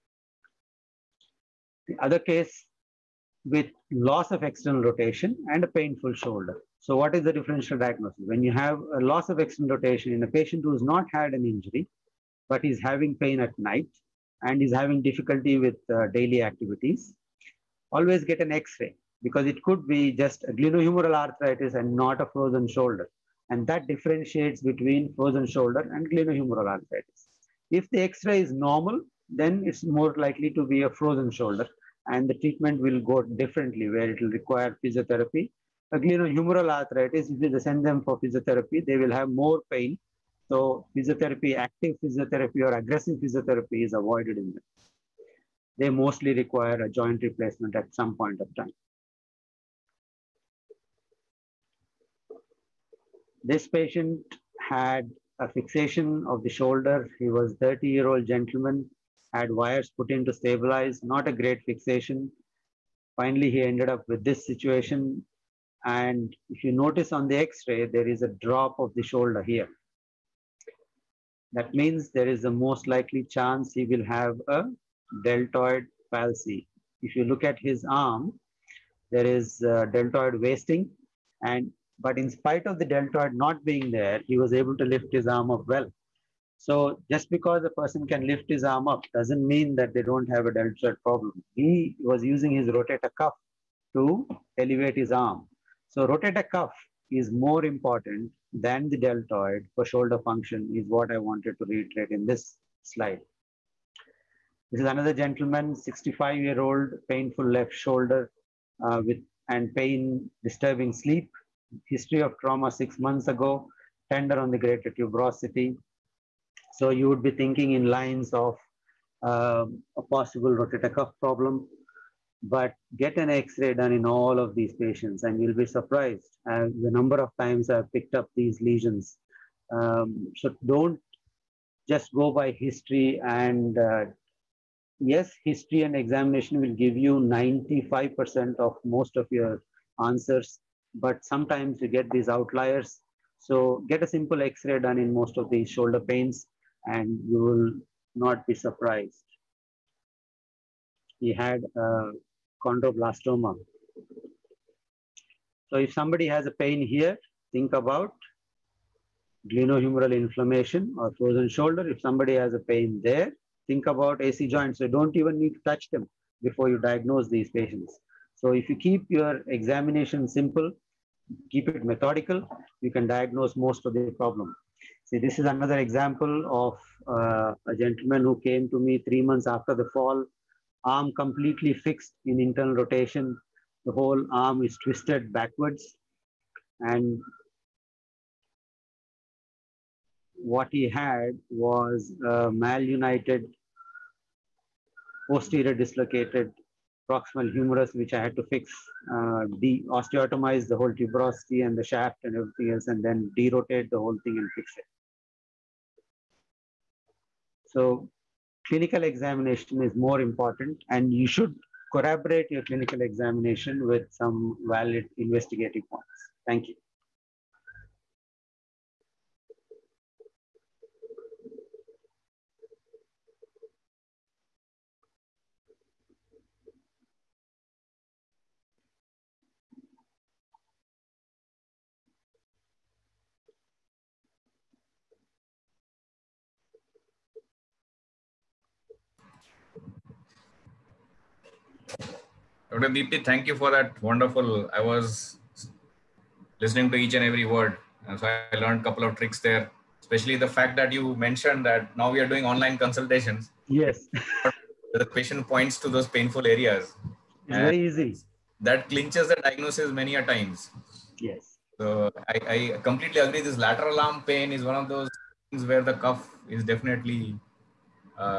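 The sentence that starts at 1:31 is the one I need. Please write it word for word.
He was using his rotator cuff to elevate his arm.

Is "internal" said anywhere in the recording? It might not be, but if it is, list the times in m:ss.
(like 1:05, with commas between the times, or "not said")
3:02.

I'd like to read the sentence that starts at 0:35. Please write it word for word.
A glenohumeral arthritis, if you send them for physiotherapy, they will have more pain.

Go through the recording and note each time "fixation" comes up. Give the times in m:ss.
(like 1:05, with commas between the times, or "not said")
0:55, 1:01.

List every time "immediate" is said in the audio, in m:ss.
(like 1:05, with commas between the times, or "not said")
not said.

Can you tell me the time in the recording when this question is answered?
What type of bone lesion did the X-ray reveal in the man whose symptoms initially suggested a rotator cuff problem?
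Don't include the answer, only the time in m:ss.
2:32.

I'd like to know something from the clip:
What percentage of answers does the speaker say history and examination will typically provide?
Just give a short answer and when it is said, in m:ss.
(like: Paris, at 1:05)
95%, at 2:17.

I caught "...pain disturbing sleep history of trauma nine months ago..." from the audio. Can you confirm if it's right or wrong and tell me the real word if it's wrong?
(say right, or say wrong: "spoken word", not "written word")
wrong: "six", not "nine".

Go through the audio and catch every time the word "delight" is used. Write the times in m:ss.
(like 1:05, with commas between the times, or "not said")
not said.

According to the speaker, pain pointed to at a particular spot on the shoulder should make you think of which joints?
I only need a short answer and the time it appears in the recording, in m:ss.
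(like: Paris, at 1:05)
AC joints, at 2:44.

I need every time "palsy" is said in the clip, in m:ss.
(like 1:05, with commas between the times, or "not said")
1:16.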